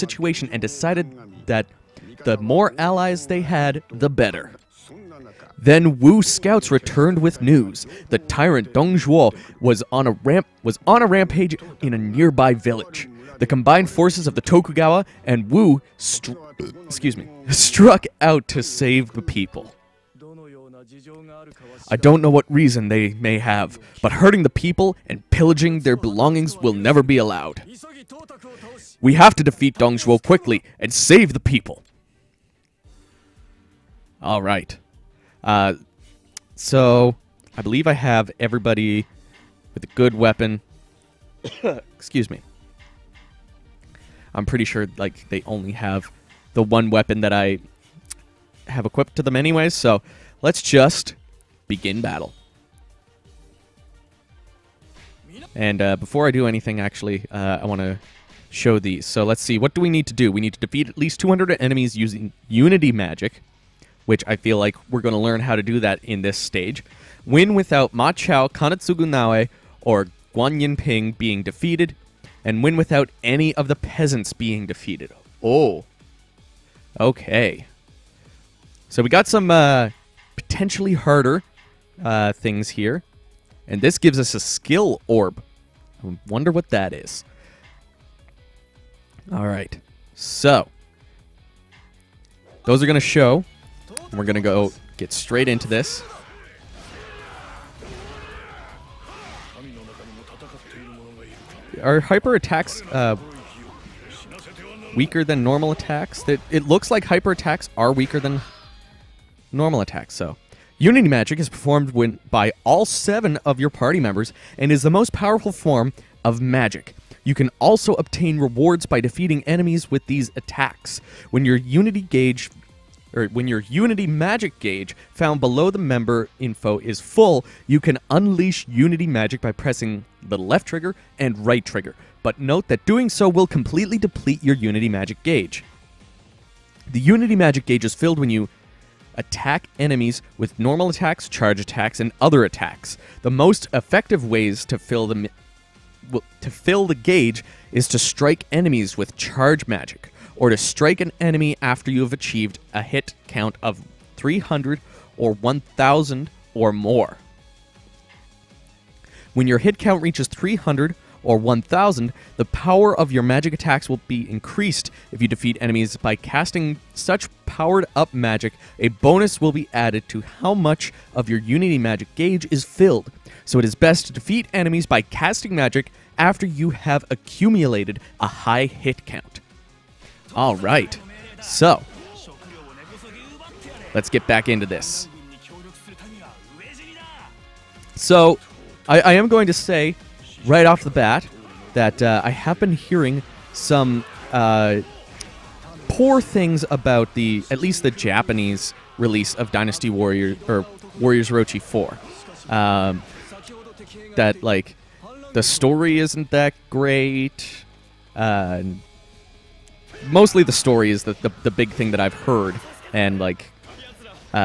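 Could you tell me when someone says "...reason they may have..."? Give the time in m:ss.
0:22.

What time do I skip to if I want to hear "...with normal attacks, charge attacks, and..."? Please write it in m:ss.
2:20.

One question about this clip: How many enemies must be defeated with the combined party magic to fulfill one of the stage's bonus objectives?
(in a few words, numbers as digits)
200.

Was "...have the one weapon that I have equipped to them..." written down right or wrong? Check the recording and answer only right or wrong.
right.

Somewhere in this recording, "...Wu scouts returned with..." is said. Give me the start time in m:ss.
0:06.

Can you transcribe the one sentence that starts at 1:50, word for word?
Unity Magic is performed when, by all seven of your party members and is the most powerful form of magic.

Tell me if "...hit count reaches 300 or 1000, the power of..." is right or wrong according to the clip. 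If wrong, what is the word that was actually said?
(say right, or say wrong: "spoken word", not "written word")
right.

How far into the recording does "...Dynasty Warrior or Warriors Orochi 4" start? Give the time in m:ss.
3:19.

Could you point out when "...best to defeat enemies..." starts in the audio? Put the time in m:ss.
2:53.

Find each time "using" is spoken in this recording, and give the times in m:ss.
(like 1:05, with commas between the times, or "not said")
1:01.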